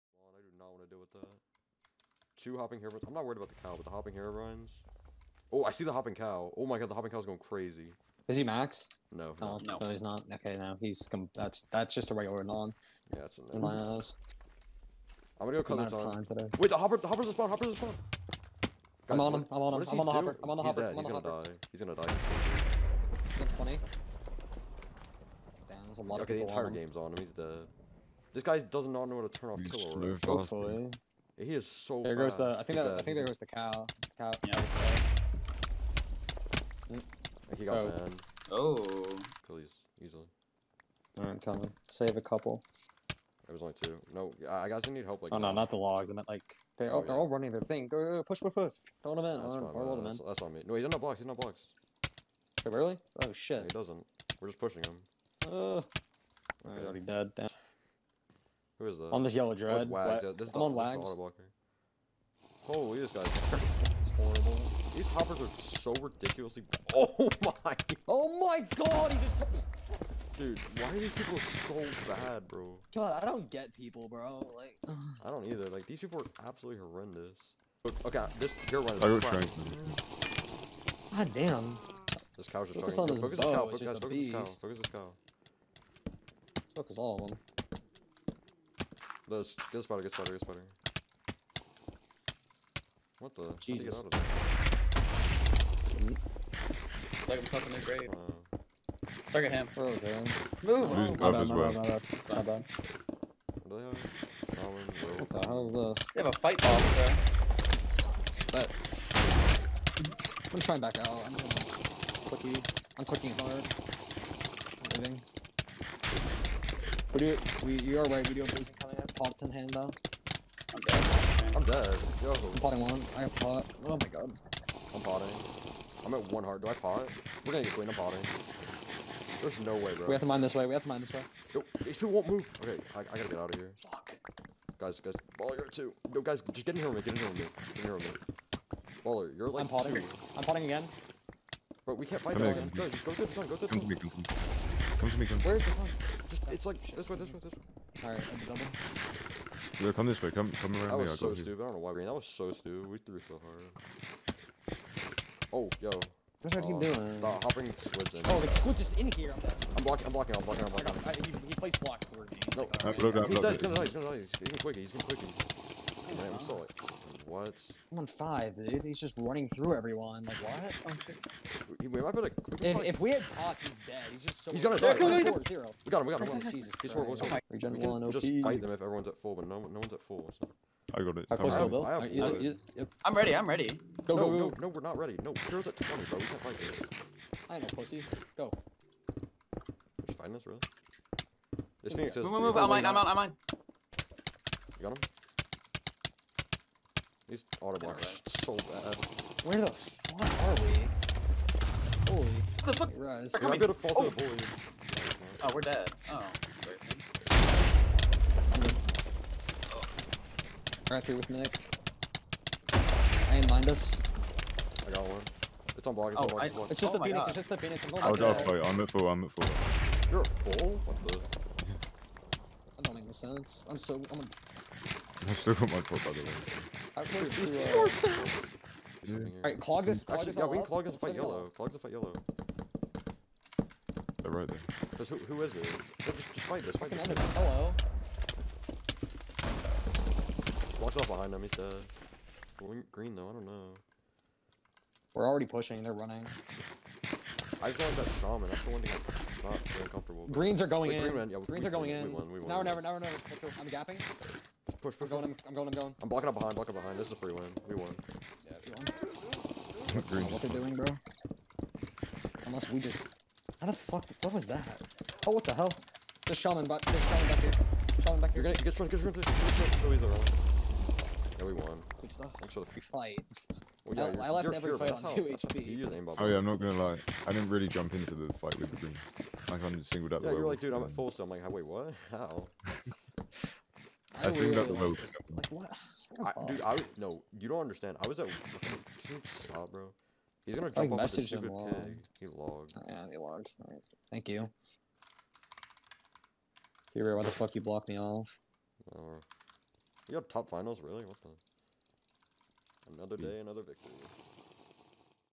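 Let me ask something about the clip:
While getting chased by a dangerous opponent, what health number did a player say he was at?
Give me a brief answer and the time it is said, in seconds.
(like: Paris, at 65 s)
5, at 167 s.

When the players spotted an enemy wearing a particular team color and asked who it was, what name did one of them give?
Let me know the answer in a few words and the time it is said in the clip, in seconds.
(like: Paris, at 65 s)
Wags, at 59 s.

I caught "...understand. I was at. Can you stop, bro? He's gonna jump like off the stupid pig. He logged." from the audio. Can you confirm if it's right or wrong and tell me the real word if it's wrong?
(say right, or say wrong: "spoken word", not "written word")
right.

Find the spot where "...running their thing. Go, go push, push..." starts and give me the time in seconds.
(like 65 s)
47 s.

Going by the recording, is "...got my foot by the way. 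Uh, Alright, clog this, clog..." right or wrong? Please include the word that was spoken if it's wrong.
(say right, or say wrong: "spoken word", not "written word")
right.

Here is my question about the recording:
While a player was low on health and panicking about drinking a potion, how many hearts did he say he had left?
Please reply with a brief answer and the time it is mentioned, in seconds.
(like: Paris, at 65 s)
1, at 126 s.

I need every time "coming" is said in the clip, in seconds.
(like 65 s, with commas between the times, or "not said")
41 s.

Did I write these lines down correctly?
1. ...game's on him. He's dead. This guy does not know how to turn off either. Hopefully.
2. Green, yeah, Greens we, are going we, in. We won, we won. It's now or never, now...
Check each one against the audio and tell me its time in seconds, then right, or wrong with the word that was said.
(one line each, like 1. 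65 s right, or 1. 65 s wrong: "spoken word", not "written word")
1. 26 s wrong: "killer", not "either"
2. 251 s right.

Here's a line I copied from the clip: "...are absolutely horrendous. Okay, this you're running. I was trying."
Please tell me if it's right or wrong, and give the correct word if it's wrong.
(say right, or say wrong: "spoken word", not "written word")
right.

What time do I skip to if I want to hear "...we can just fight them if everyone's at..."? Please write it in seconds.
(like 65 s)
177 s.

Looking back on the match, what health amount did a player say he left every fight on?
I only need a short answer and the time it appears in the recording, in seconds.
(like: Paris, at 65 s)
2 HP, at 275 s.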